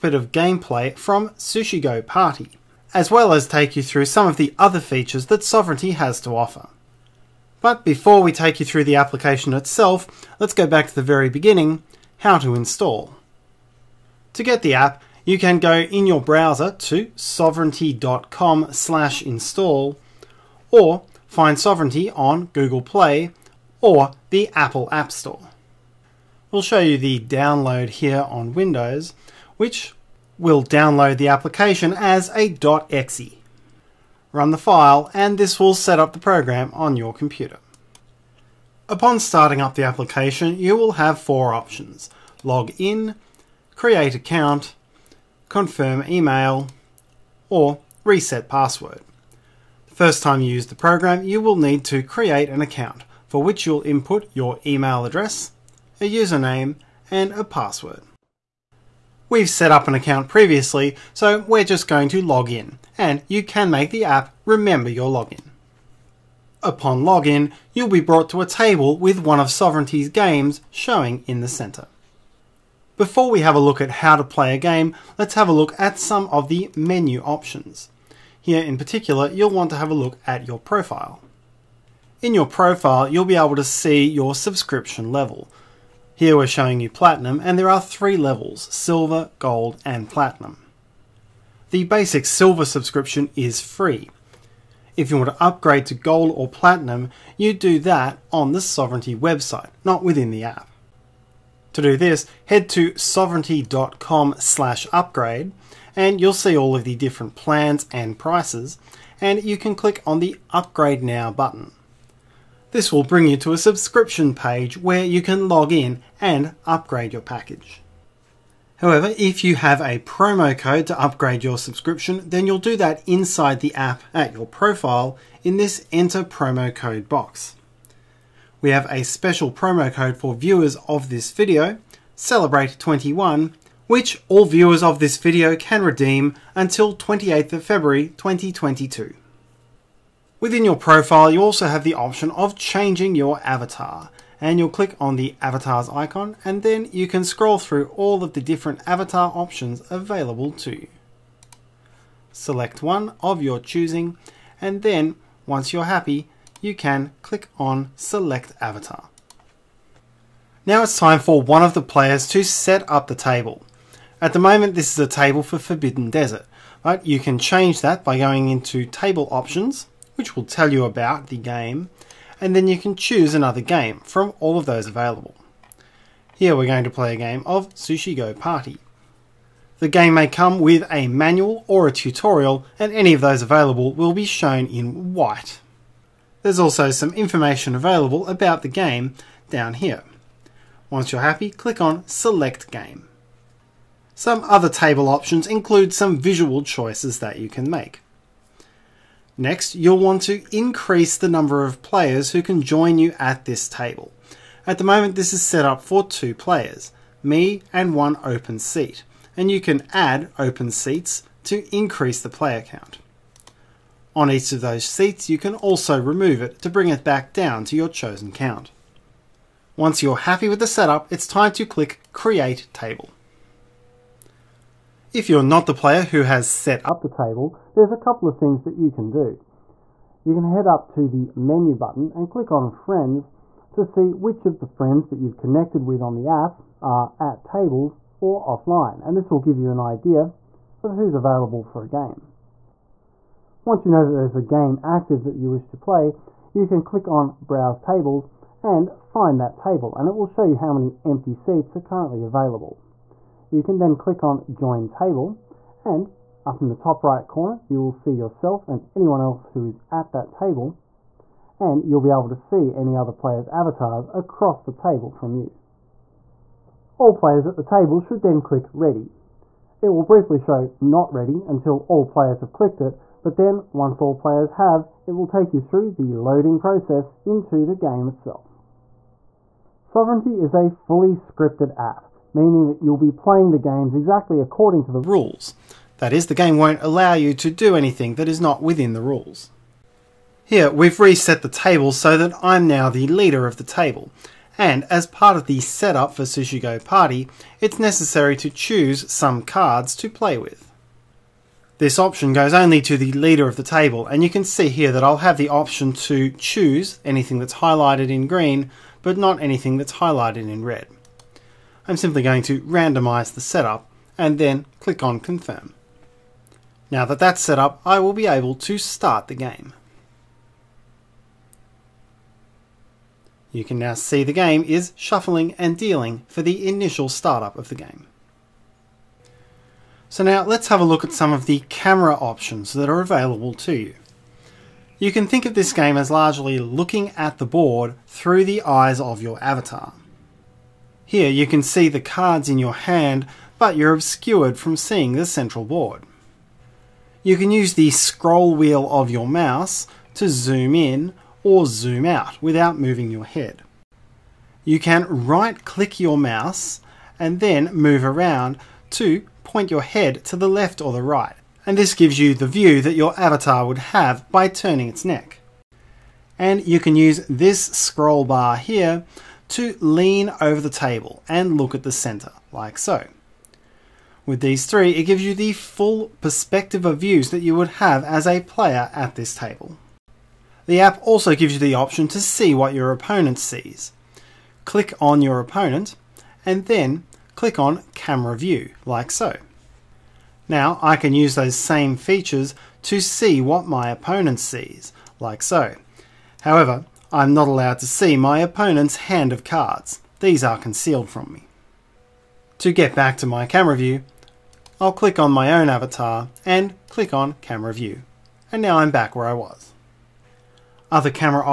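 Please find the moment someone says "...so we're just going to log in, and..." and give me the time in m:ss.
1:01.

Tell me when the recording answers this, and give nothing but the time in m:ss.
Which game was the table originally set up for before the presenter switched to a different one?
2:45.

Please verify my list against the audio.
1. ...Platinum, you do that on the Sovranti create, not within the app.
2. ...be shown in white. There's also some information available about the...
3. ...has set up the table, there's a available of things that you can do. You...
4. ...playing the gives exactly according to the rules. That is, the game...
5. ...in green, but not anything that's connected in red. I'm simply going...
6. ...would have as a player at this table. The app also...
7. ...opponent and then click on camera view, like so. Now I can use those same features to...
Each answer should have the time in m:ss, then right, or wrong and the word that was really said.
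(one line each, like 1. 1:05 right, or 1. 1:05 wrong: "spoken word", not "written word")
1. 1:36 wrong: "website", not "create"
2. 3:04 right
3. 3:46 wrong: "couple", not "available"
4. 4:43 wrong: "games", not "gives"
5. 5:08 wrong: "highlighted", not "connected"
6. 6:17 right
7. 6:25 right.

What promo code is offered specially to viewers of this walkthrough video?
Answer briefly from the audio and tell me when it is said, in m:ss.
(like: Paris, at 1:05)
Celebrate21, at 2:12.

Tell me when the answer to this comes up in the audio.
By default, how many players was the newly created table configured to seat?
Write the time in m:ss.
3:26.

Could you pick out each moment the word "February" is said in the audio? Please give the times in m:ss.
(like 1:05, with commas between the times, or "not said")
2:17.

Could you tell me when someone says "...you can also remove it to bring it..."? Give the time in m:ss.
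3:35.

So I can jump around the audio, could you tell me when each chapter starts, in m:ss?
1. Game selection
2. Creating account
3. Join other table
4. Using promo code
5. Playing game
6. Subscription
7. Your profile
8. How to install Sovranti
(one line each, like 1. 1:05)
1. 2:39
2. 0:37
3. 3:43
4. 2:07
5. 4:38
6. 1:23
7. 1:05
8. 0:06.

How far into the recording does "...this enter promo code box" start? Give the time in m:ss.
2:05.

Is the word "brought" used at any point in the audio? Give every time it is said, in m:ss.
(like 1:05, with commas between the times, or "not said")
1:07.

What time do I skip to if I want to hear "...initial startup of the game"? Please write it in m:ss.
5:26.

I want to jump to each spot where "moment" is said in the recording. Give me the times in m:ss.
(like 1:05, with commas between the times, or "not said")
2:44, 3:24.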